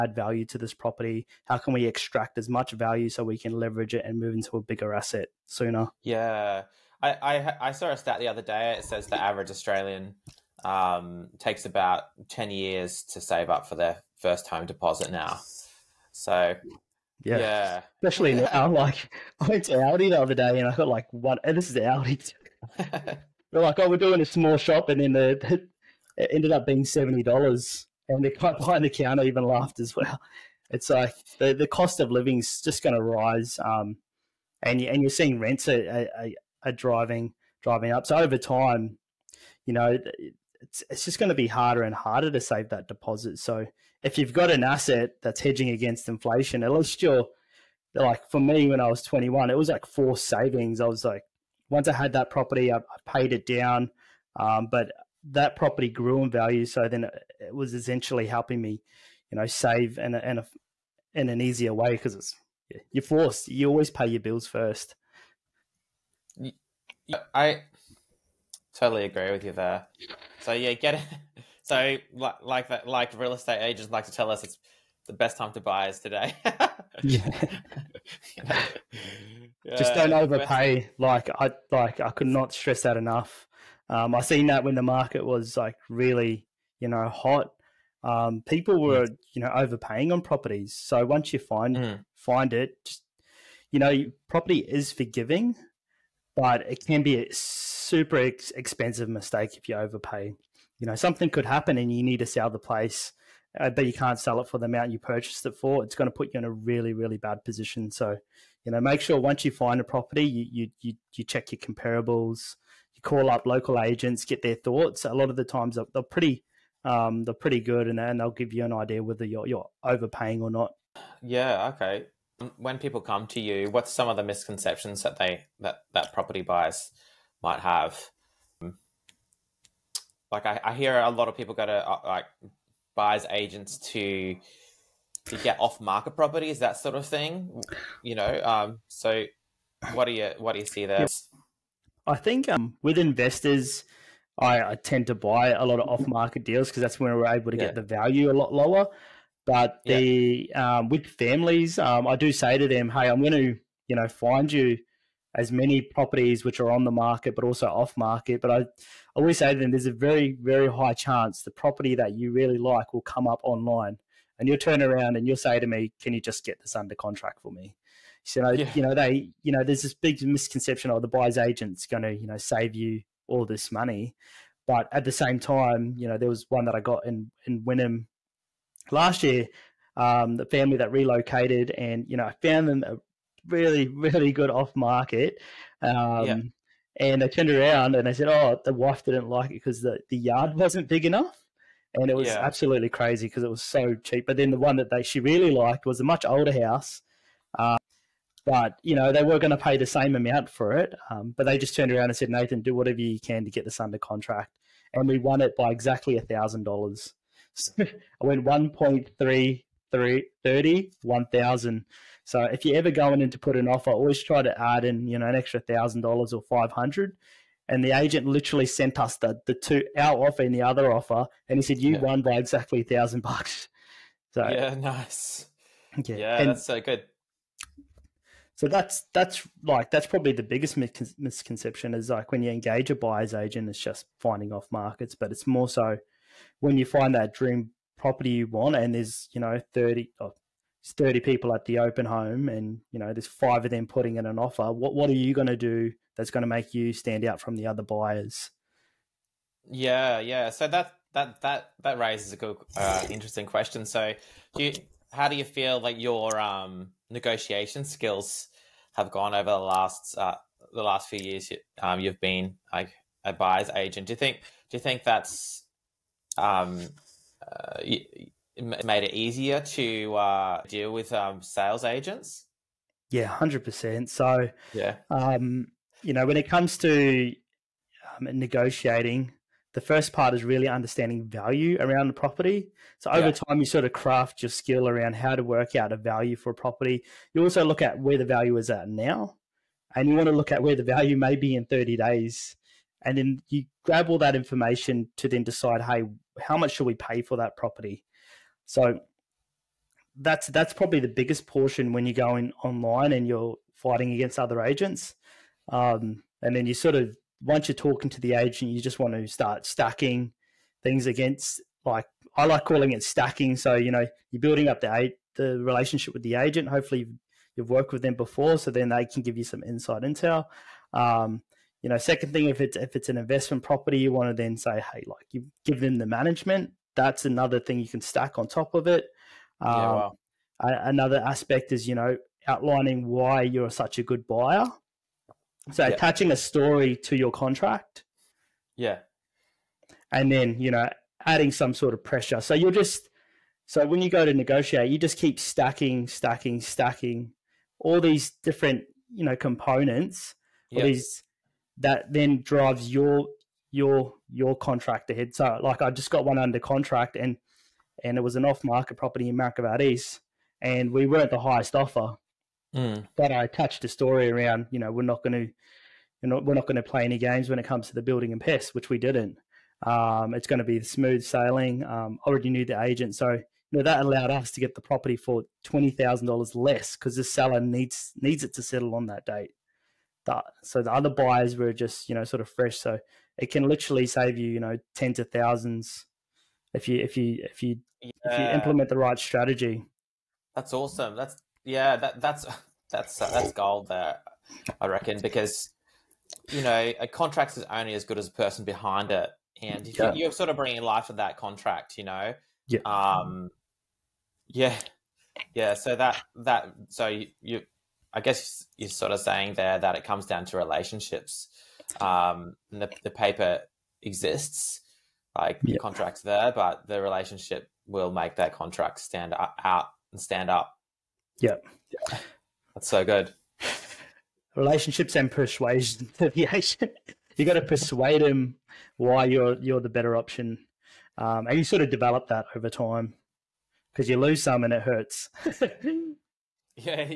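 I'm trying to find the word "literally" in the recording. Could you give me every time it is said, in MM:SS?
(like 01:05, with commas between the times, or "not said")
03:38, 06:23.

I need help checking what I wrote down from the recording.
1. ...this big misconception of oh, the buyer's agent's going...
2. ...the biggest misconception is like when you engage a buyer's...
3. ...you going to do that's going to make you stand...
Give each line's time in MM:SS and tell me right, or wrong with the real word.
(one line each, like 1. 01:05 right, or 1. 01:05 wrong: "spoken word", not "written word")
1. 02:49 right
2. 03:50 right
3. 04:05 right.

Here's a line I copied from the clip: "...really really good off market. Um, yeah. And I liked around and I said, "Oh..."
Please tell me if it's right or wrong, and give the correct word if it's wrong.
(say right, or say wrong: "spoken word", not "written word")
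wrong: "turned", not "liked".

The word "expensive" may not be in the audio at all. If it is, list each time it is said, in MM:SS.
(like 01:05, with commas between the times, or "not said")
01:38.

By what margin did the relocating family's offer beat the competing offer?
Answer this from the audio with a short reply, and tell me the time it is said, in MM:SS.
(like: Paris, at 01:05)
$1,000, at 03:26.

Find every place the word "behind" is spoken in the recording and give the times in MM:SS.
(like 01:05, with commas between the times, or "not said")
00:28, 06:38.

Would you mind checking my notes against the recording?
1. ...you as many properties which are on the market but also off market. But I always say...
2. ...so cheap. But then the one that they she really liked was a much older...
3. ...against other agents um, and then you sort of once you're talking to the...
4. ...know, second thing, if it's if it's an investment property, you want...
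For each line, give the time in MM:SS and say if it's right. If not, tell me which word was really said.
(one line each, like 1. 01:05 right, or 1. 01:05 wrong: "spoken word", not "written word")
1. 02:34 right
2. 03:13 right
3. 05:04 right
4. 05:21 right.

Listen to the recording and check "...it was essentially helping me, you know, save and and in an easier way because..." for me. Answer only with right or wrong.
right.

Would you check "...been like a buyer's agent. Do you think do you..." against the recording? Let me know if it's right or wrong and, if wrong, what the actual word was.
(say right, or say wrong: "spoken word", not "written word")
right.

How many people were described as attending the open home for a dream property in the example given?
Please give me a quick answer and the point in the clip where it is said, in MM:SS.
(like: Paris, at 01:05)
30, at 04:00.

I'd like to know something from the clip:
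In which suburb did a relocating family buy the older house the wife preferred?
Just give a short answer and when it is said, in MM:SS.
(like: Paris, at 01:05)
Wynnum, at 02:57.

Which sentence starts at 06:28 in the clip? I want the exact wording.
if you implement the right strategy.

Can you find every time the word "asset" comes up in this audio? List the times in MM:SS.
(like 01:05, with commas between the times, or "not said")
00:04, 00:44.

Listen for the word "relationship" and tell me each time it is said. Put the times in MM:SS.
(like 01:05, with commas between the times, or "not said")
05:15, 06:50, 06:57, 07:04.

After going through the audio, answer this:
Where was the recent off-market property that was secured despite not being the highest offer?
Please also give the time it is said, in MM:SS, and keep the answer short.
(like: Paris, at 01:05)
Mount Gravatt East, at 05:59.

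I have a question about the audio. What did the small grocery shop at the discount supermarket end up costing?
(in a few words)
$70.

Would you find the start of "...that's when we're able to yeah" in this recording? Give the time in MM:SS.
02:26.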